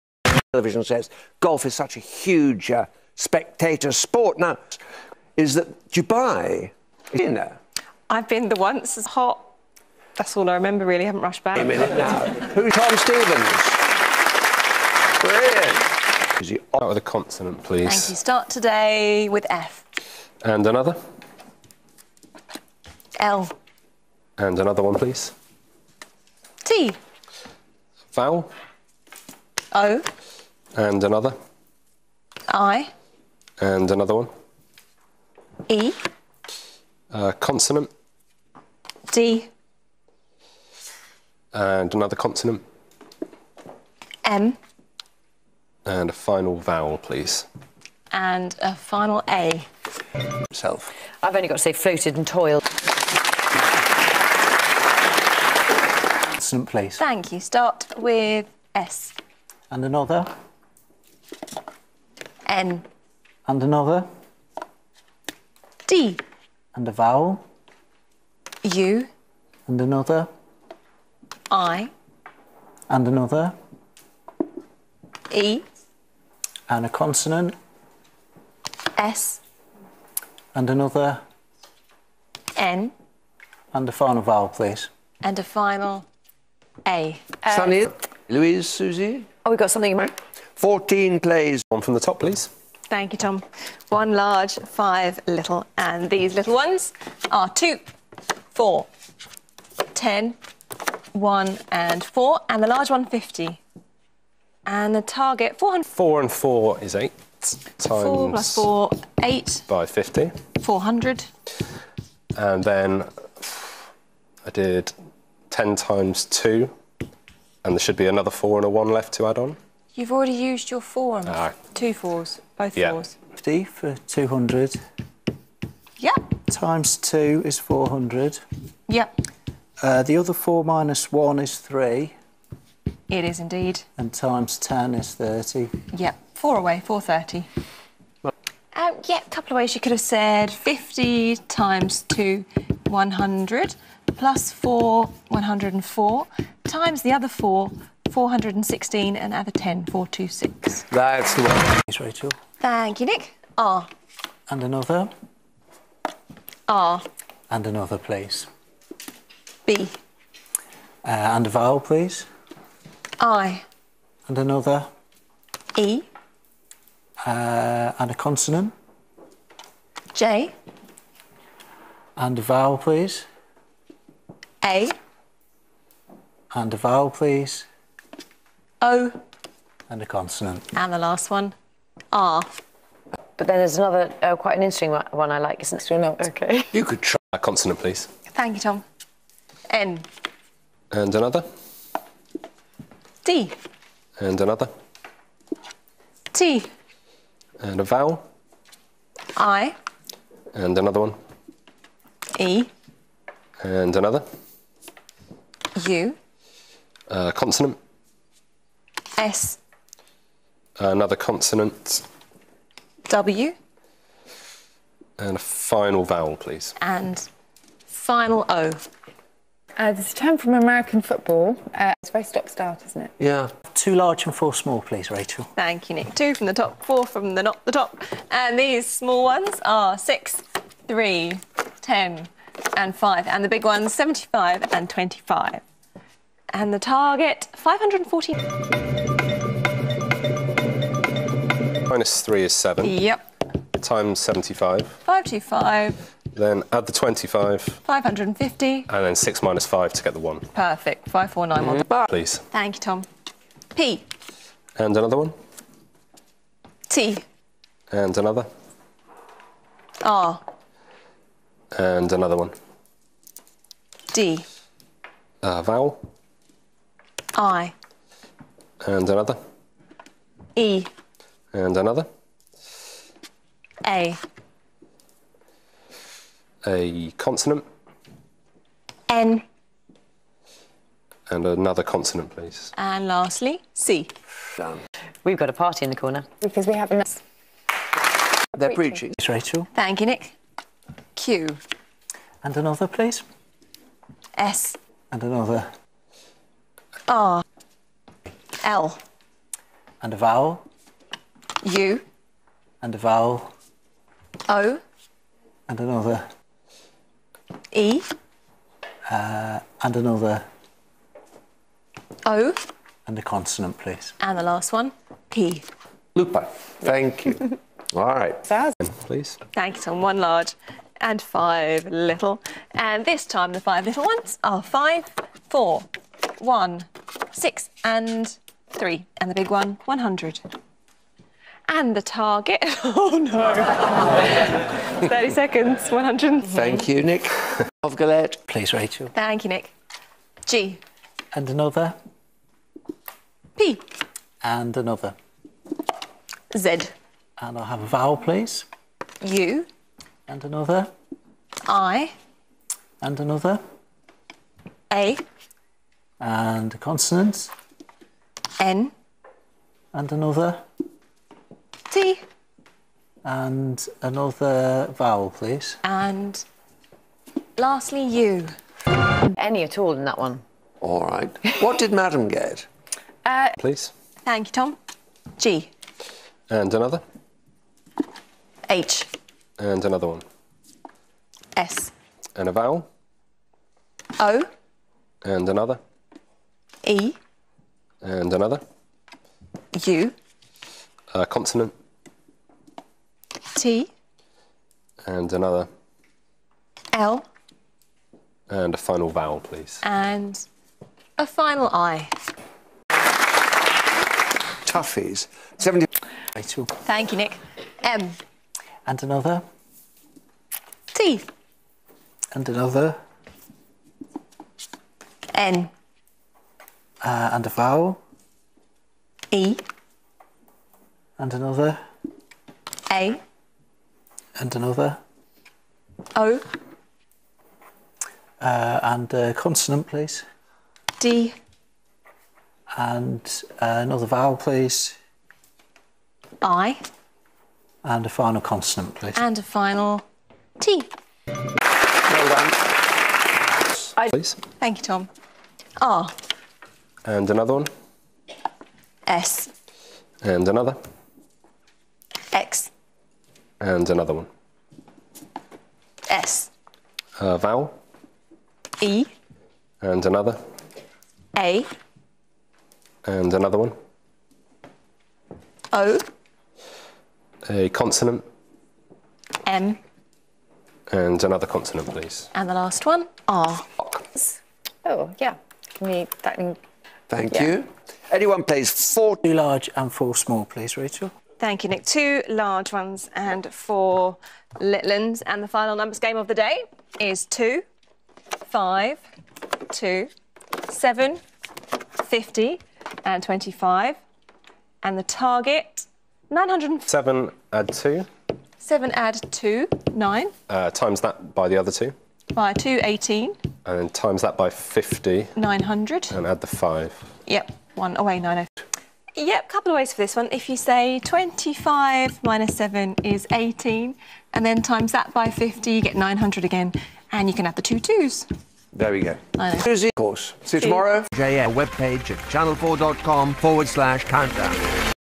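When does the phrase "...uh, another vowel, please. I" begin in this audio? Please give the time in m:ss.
7:13.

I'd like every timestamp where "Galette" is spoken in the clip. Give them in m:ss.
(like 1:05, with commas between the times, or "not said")
5:37.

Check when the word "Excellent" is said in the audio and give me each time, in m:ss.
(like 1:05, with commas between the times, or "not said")
0:56.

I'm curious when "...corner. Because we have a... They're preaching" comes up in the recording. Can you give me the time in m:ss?
4:45.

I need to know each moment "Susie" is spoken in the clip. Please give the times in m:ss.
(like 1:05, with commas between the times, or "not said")
1:28, 8:39.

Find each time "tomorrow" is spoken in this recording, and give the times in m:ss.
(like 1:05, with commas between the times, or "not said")
8:40.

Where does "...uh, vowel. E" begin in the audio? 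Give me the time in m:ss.
7:37.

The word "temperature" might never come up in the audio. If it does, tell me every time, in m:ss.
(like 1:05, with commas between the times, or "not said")
not said.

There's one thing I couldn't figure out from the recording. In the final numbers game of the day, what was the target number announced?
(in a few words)
907.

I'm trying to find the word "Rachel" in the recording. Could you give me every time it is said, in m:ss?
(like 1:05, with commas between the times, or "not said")
2:31, 3:45, 4:49, 5:38, 8:00.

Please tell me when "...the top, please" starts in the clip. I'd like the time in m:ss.
1:31.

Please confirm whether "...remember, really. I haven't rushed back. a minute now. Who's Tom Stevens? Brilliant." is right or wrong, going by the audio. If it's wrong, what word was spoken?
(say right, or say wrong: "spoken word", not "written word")
right.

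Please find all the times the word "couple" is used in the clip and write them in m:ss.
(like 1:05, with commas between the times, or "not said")
2:19, 8:29.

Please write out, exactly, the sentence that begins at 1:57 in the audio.
And there should be another four and a one left to add on.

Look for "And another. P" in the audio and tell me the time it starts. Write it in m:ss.
5:41.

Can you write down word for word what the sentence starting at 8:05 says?
And the final numbers game of the day is two, five, two, seven, fifty, and 25.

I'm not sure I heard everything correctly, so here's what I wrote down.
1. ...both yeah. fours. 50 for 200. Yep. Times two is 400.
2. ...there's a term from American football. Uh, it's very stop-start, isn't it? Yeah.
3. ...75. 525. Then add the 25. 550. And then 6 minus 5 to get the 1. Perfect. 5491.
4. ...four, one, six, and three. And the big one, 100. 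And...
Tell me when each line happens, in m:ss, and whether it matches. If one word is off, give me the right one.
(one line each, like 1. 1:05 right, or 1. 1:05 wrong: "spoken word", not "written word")
1. 2:02 right
2. 3:39 right
3. 4:04 right
4. 5:25 right.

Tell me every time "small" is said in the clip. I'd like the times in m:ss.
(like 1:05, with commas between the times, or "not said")
3:44, 3:48, 8:00.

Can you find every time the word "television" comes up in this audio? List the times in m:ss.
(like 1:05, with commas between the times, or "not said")
0:00.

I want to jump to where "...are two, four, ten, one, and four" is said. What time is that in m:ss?
1:37.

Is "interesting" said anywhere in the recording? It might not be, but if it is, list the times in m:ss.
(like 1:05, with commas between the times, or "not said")
3:04.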